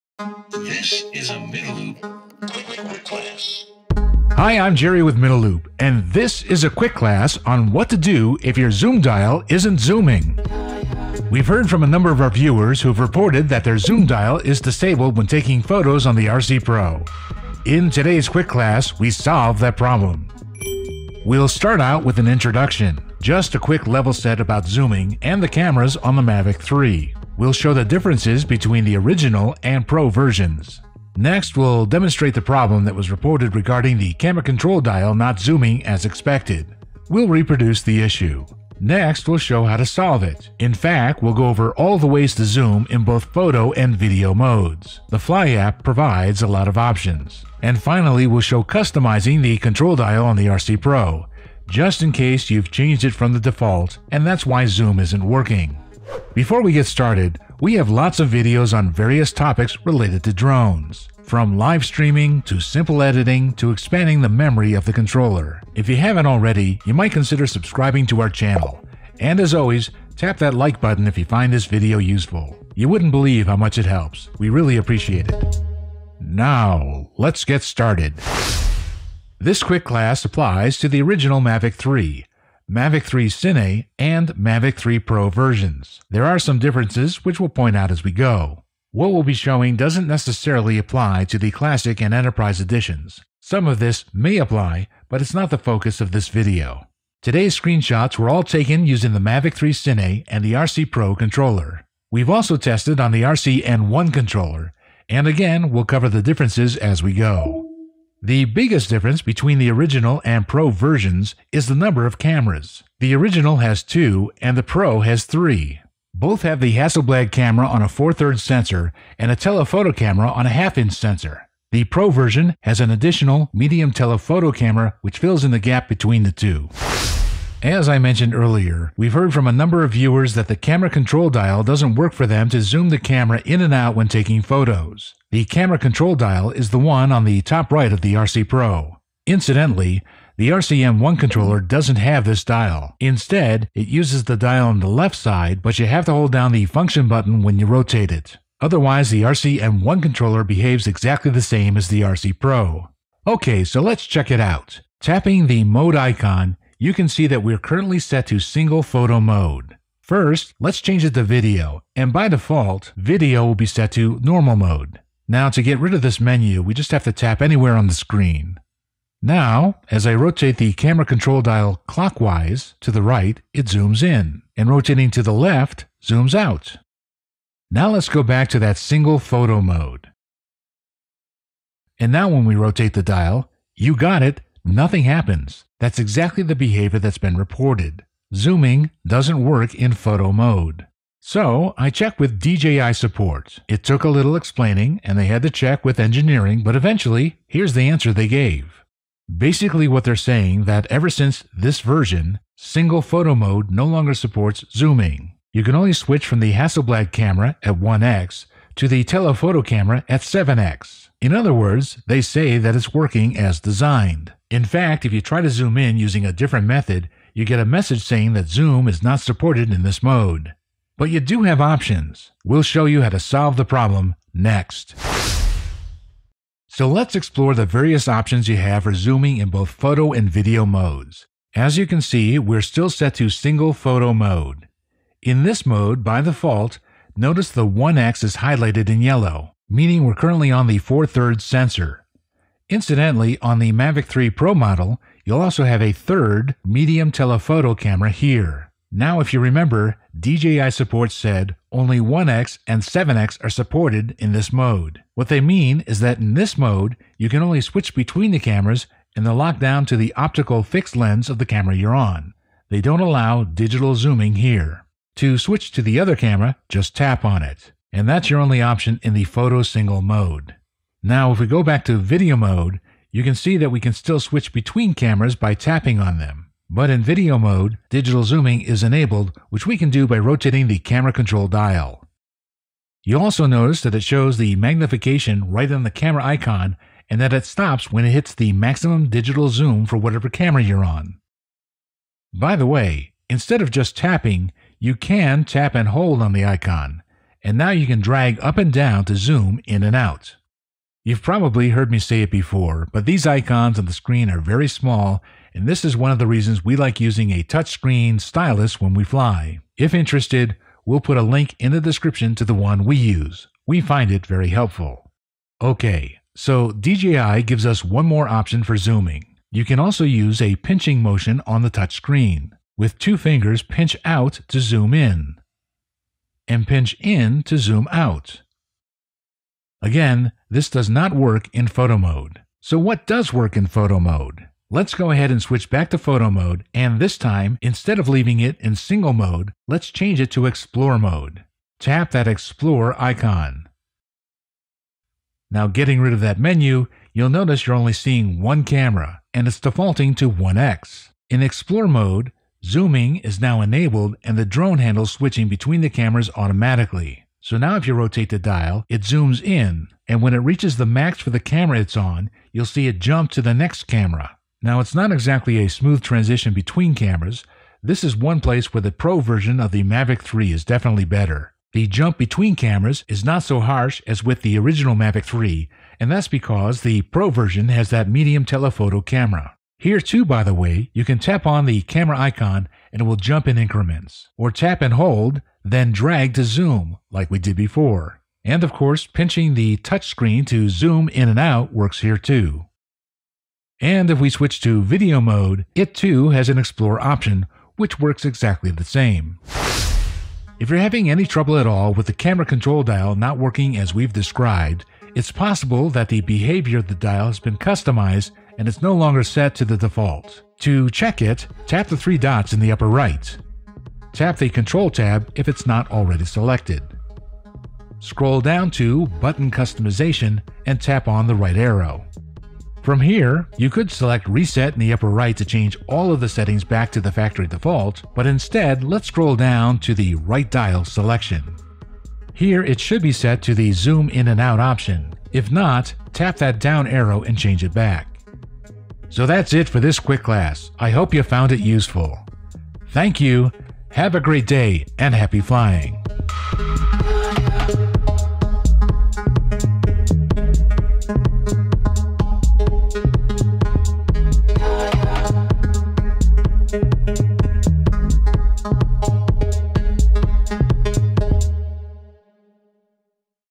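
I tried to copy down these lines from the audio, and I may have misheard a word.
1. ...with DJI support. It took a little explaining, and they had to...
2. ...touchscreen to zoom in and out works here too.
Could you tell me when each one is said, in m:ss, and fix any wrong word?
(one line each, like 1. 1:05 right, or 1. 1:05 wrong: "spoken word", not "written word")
1. 3:12 right
2. 6:29 right.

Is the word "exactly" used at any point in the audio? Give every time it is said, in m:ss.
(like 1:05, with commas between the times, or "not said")
2:30, 3:05, 6:05, 6:38.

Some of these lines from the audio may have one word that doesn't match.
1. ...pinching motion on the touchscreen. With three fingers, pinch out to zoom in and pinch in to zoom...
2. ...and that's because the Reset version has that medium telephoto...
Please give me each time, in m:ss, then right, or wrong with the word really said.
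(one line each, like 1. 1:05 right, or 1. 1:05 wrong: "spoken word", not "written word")
1. 5:20 wrong: "two", not "three"
2. 6:15 wrong: "Pro", not "Reset".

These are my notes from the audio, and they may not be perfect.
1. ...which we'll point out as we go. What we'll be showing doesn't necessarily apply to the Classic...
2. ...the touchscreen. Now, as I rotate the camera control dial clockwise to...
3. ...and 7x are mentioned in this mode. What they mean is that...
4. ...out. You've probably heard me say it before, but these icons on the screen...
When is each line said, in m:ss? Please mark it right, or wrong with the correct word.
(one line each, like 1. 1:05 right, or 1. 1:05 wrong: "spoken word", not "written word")
1. 1:27 right
2. 2:47 wrong: "screen", not "touchscreen"
3. 4:12 wrong: "supported", not "mentioned"
4. 4:59 right.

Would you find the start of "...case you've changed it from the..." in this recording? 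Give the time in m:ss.
0:52.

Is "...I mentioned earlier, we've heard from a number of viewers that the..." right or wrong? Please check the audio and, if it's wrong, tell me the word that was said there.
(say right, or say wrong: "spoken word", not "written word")
right.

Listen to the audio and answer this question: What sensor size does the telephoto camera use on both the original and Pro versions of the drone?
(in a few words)
half inch.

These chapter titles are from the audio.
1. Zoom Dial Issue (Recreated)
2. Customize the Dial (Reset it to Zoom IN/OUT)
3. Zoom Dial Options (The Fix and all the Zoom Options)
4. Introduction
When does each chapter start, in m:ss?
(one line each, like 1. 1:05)
1. 2:07
2. 6:39
3. 3:45
4. 1:18.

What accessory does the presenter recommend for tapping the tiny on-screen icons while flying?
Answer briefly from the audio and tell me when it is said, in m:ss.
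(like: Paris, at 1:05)
touchscreen stylus, at 5:07.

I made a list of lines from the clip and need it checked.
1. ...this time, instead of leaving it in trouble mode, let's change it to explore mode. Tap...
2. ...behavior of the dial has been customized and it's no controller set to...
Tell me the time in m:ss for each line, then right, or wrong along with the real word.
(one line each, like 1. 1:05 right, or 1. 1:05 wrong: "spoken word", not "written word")
1. 5:36 wrong: "single", not "trouble"
2. 6:46 wrong: "longer", not "controller".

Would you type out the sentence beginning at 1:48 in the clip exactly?
The biggest difference between the original and Pro versions is the number of cameras.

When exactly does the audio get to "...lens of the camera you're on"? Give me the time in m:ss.
4:20.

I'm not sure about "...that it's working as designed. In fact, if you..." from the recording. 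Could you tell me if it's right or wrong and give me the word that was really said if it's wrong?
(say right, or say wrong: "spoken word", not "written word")
right.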